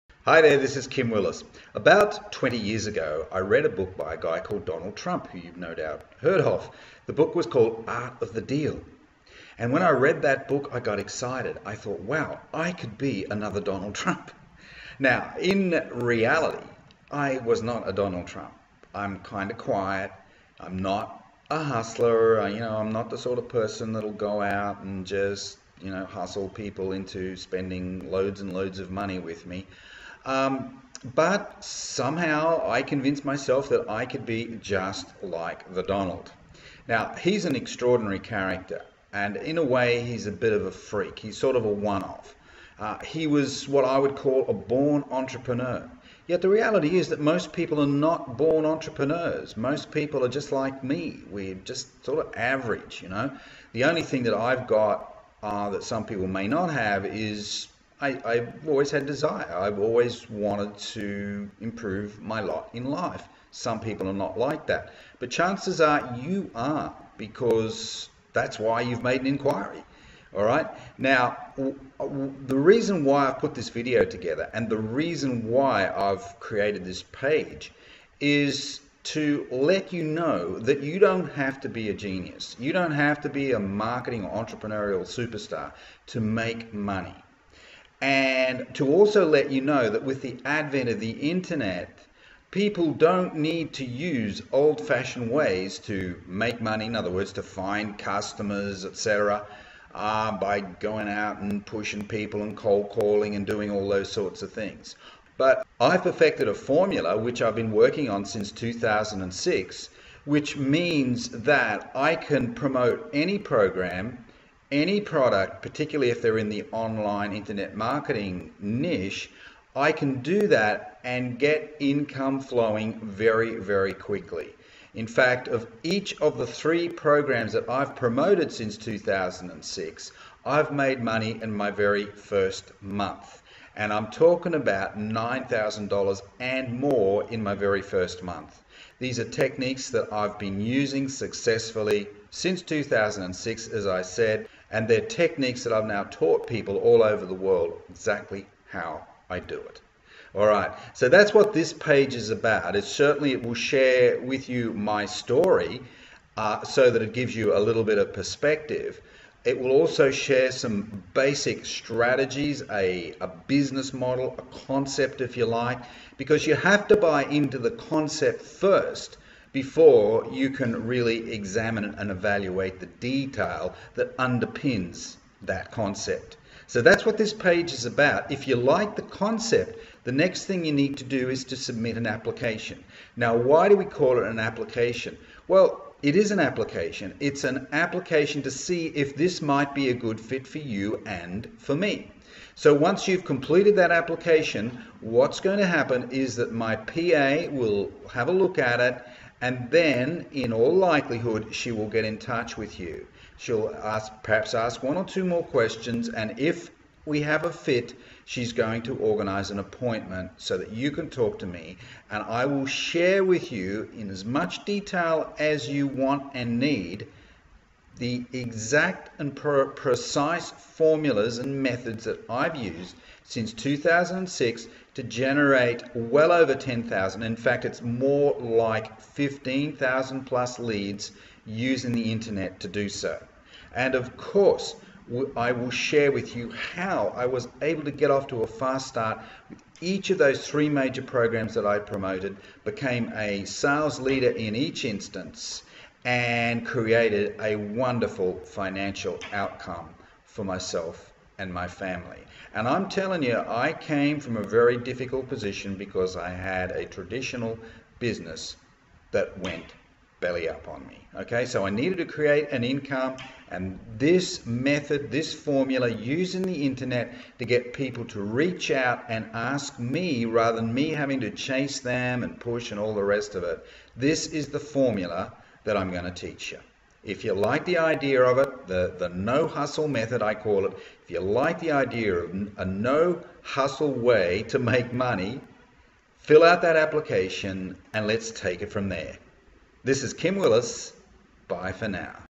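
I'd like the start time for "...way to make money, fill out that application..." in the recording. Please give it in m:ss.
4:43.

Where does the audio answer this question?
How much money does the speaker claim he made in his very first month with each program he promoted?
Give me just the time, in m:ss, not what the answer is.
2:14.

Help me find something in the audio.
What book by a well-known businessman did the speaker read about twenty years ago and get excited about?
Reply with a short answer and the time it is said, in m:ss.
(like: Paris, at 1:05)
Art of the Deal, at 0:07.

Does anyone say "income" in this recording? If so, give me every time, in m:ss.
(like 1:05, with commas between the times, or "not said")
2:01, 4:22.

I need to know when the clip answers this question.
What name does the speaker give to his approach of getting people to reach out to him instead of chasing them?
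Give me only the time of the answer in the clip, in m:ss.
4:38.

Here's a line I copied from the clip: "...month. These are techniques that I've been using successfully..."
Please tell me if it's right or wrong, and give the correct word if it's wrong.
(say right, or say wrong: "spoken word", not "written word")
right.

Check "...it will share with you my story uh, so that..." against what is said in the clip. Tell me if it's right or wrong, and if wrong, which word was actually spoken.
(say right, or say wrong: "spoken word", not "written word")
right.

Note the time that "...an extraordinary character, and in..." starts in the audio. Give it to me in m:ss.
0:37.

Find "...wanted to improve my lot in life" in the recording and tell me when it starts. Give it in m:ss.
1:00.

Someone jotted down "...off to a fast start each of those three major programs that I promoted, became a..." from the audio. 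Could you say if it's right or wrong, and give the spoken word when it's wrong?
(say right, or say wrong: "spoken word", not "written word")
right.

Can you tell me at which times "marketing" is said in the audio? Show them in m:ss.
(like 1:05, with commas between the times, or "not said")
1:23, 1:57.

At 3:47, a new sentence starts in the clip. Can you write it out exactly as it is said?
In fact, it's more like 15,000 plus leads using the internet to do so.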